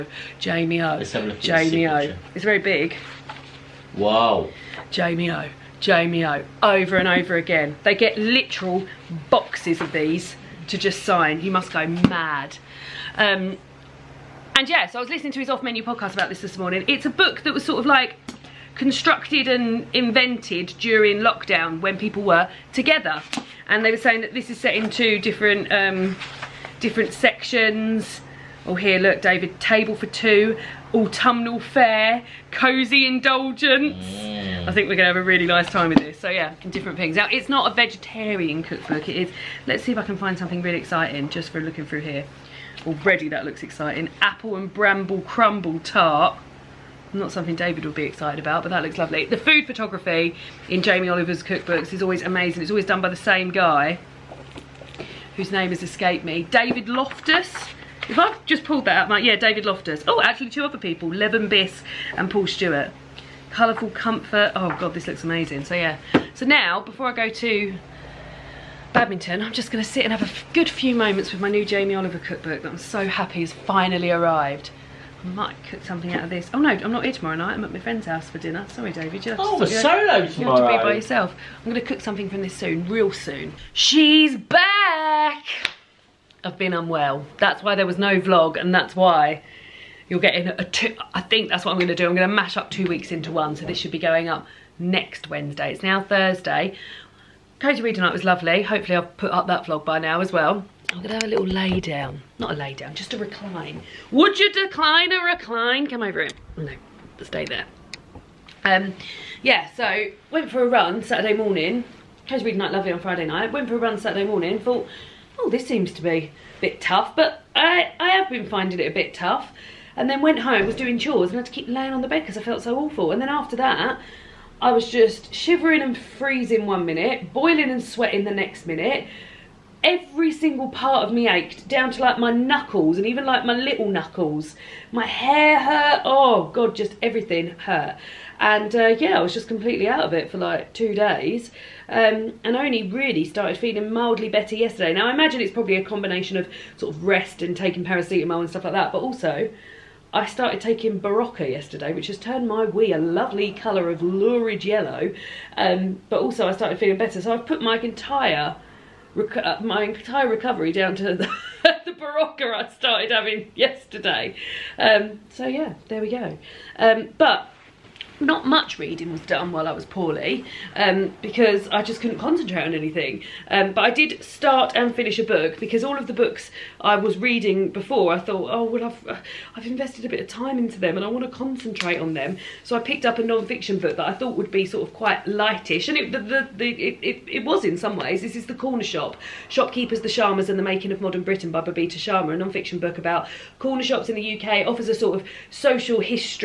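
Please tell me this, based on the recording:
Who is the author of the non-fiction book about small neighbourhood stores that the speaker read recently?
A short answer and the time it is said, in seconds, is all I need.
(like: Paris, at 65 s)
Babita Sharma, at 191 s.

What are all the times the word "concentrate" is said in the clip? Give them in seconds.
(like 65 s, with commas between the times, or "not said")
172 s, 181 s.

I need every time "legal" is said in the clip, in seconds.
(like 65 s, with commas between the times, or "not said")
not said.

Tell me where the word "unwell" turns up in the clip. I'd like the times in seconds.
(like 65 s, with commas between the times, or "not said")
86 s.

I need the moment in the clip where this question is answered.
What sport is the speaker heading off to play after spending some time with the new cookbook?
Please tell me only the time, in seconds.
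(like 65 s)
68 s.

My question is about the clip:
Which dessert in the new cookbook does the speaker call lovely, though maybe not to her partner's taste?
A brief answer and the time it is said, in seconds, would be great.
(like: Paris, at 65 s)
Apple and bramble crumble tart, at 44 s.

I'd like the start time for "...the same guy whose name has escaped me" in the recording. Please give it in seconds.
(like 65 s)
53 s.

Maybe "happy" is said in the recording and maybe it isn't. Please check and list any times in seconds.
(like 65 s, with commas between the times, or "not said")
73 s.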